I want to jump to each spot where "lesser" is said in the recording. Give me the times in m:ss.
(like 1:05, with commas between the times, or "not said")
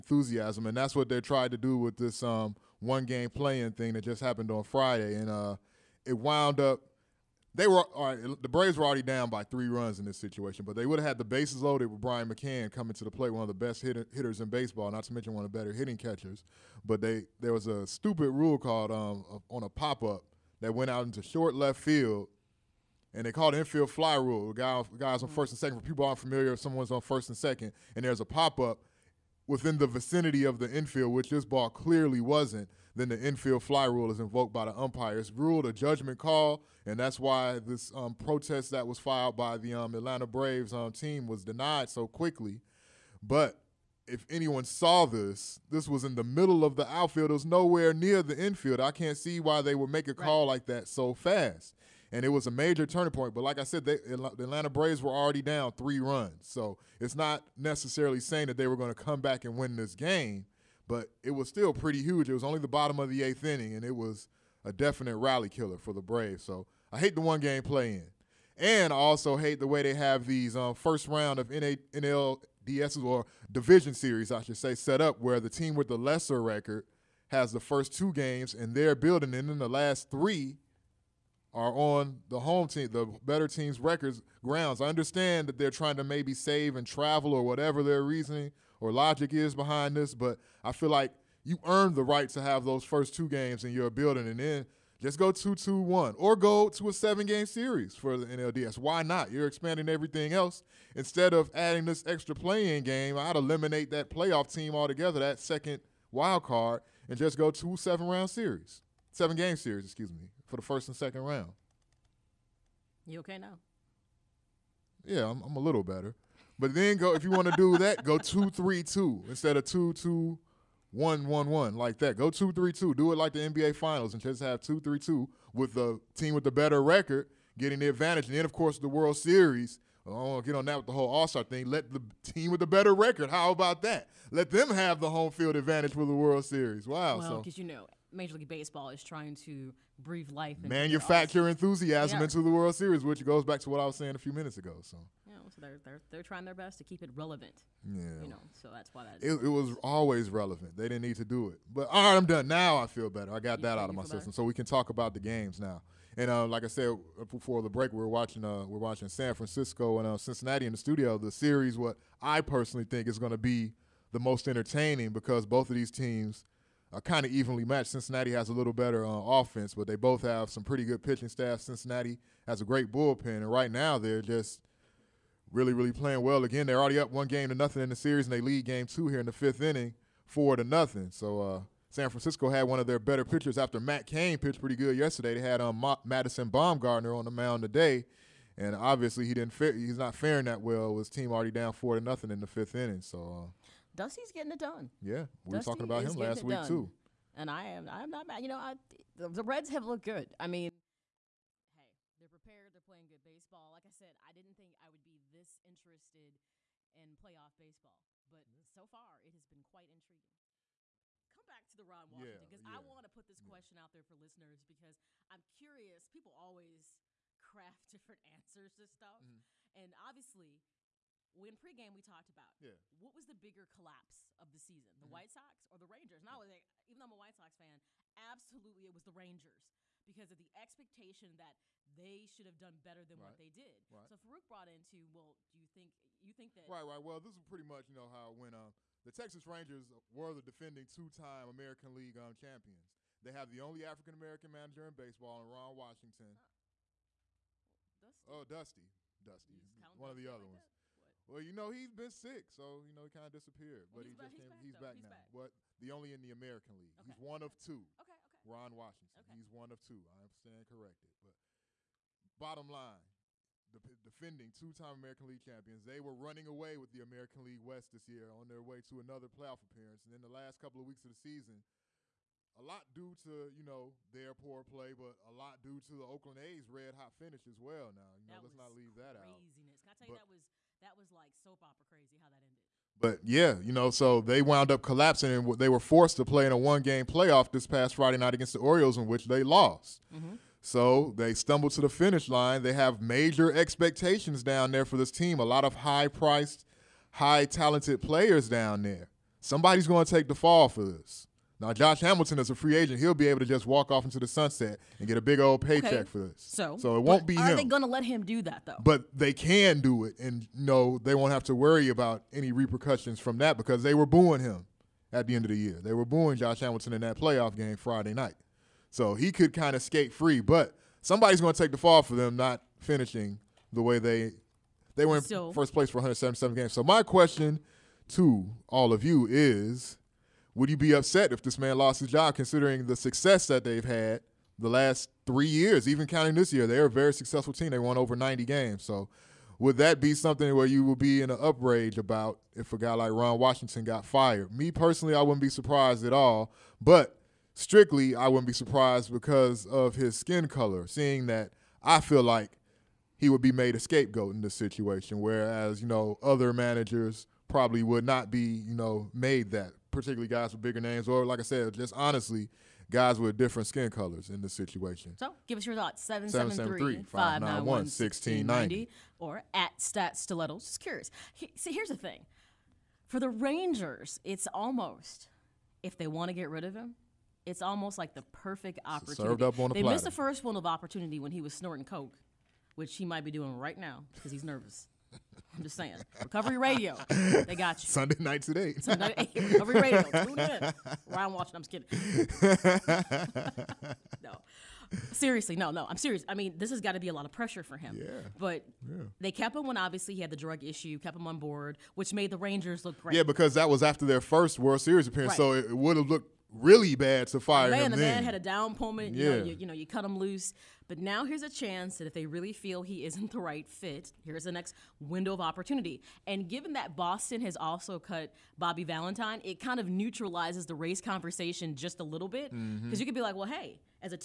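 1:15.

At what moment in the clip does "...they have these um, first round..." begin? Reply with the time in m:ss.
1:09.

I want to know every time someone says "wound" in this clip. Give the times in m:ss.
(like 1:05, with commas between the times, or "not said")
0:06, 4:44.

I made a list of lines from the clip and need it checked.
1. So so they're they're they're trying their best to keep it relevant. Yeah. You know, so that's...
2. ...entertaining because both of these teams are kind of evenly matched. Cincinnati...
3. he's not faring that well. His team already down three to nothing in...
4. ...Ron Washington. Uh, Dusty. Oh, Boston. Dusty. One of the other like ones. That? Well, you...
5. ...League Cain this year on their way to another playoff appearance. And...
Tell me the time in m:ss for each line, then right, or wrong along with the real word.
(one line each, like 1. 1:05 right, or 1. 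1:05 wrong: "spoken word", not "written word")
1. 2:24 right
2. 2:44 right
3. 3:09 wrong: "four", not "three"
4. 4:05 wrong: "Dusty", not "Boston"
5. 4:27 wrong: "West", not "Cain".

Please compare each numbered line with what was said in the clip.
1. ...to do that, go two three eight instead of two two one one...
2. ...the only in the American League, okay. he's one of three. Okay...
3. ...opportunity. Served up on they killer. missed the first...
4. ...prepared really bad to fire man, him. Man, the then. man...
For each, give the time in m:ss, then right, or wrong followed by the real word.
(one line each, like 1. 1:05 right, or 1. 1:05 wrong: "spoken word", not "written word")
1. 1:57 wrong: "two", not "eight"
2. 4:15 wrong: "two", not "three"
3. 6:18 wrong: "platter", not "killer"
4. 6:46 wrong: "looked", not "prepared".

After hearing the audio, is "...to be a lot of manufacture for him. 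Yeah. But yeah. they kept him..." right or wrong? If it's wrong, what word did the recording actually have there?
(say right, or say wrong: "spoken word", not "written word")
wrong: "pressure", not "manufacture".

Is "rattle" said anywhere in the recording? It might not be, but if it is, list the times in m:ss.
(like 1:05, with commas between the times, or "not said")
not said.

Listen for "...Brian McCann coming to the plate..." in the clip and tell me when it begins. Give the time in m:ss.
0:11.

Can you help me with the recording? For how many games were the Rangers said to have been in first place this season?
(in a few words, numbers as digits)
177.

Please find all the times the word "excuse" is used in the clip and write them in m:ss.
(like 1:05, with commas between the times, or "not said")
1:49.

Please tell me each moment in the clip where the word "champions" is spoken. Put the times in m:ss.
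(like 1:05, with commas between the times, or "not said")
4:02, 4:25.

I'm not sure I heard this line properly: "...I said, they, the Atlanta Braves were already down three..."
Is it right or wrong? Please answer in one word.
right.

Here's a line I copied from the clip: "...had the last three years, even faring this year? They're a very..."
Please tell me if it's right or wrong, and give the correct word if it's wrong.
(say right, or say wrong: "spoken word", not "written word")
wrong: "counting", not "faring".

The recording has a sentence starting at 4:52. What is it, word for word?
They have major expectations down there for this team.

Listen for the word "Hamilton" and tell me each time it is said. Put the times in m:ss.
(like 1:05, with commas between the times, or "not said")
5:02, 5:16.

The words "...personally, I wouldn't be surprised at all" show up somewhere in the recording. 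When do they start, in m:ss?
5:44.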